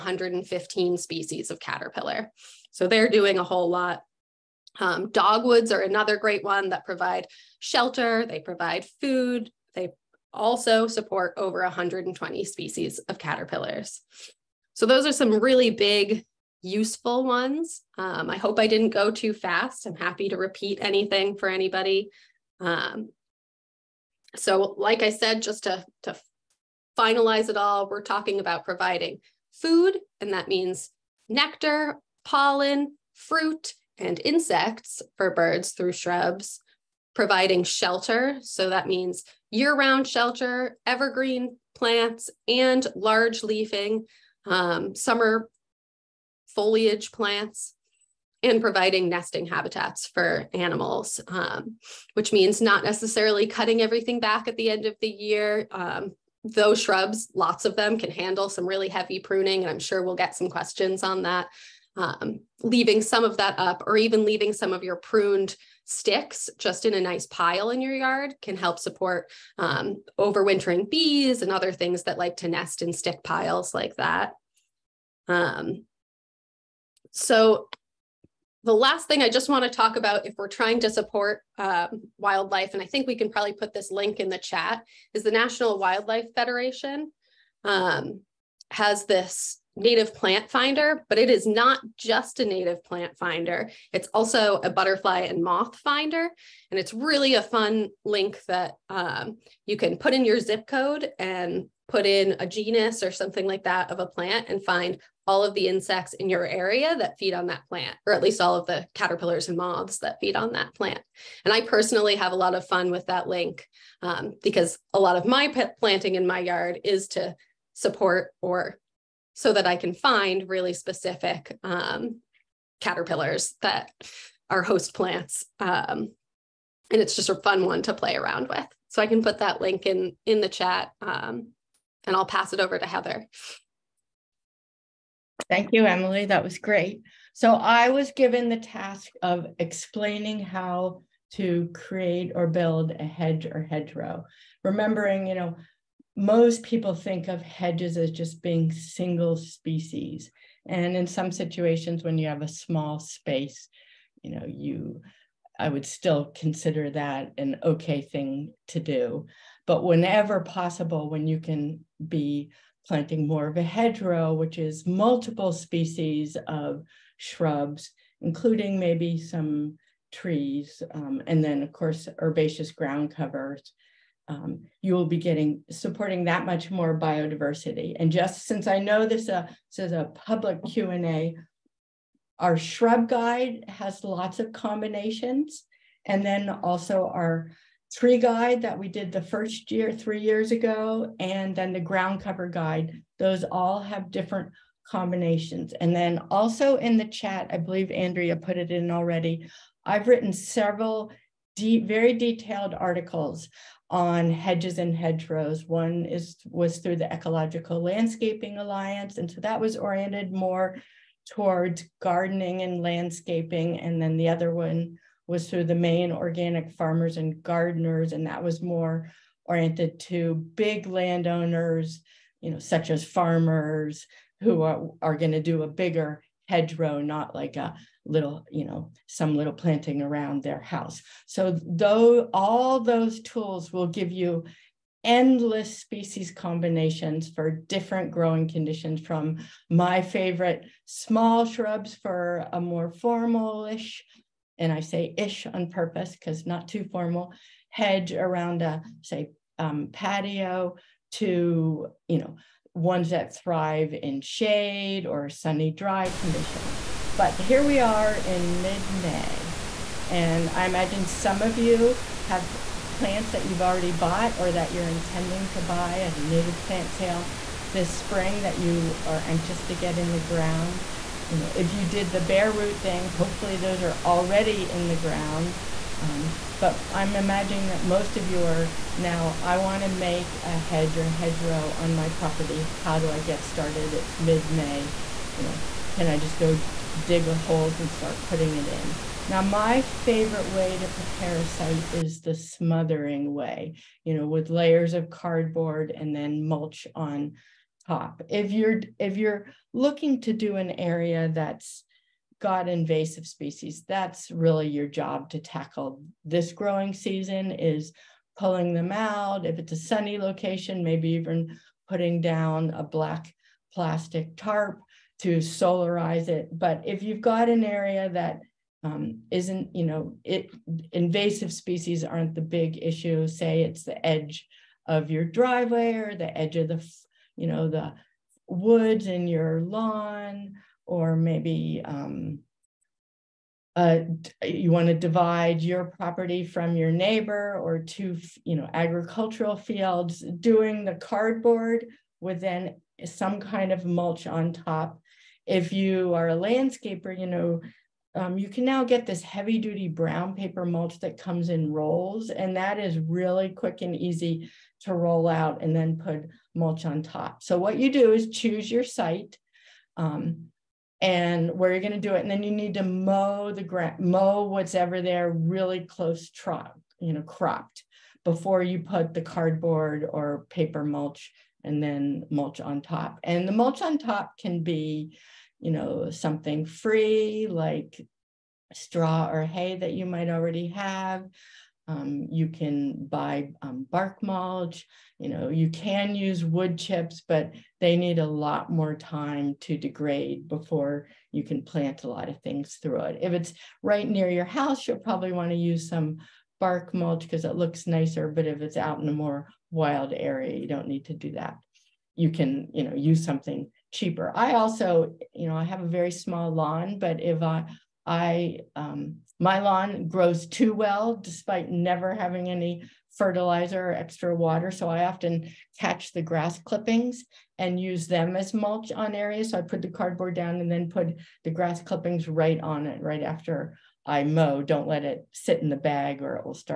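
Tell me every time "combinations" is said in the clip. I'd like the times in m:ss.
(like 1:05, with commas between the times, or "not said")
3:04, 3:14, 3:56.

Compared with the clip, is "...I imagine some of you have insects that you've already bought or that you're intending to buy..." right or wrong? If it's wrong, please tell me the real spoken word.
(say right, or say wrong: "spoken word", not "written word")
wrong: "plants", not "insects".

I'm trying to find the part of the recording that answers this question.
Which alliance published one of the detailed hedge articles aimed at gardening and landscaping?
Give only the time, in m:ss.
3:27.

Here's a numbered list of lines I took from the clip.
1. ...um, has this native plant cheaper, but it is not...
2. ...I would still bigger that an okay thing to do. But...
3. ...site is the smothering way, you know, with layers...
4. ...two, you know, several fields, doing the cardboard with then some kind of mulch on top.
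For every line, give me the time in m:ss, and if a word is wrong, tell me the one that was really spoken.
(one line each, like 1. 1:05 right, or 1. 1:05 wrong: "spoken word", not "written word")
1. 1:27 wrong: "finder", not "cheaper"
2. 2:35 wrong: "consider", not "bigger"
3. 4:51 right
4. 5:37 wrong: "agricultural", not "several".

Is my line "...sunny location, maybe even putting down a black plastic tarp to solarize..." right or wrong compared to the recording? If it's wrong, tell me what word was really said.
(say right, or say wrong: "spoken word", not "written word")
right.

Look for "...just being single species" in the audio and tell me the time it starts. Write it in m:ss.
2:28.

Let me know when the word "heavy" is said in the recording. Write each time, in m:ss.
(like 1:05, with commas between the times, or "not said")
0:58, 5:49.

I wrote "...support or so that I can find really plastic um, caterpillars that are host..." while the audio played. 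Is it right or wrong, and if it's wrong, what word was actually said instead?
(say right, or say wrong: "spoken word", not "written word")
wrong: "specific", not "plastic".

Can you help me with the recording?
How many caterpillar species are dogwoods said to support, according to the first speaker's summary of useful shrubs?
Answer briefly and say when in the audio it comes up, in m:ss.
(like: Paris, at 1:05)
over 120, at 0:11.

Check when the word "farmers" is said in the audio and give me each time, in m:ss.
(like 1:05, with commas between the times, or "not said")
3:36, 3:43.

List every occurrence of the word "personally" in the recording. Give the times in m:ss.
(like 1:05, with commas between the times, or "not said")
1:51.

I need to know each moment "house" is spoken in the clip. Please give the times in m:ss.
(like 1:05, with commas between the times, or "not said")
3:50, 6:34.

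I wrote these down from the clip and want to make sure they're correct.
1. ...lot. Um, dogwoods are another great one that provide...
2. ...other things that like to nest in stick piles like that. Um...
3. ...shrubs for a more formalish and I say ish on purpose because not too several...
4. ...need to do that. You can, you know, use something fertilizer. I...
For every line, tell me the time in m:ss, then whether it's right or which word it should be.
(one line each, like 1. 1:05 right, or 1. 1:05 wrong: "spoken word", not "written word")
1. 0:03 right
2. 1:11 right
3. 4:01 wrong: "formal", not "several"
4. 6:40 wrong: "cheaper", not "fertilizer".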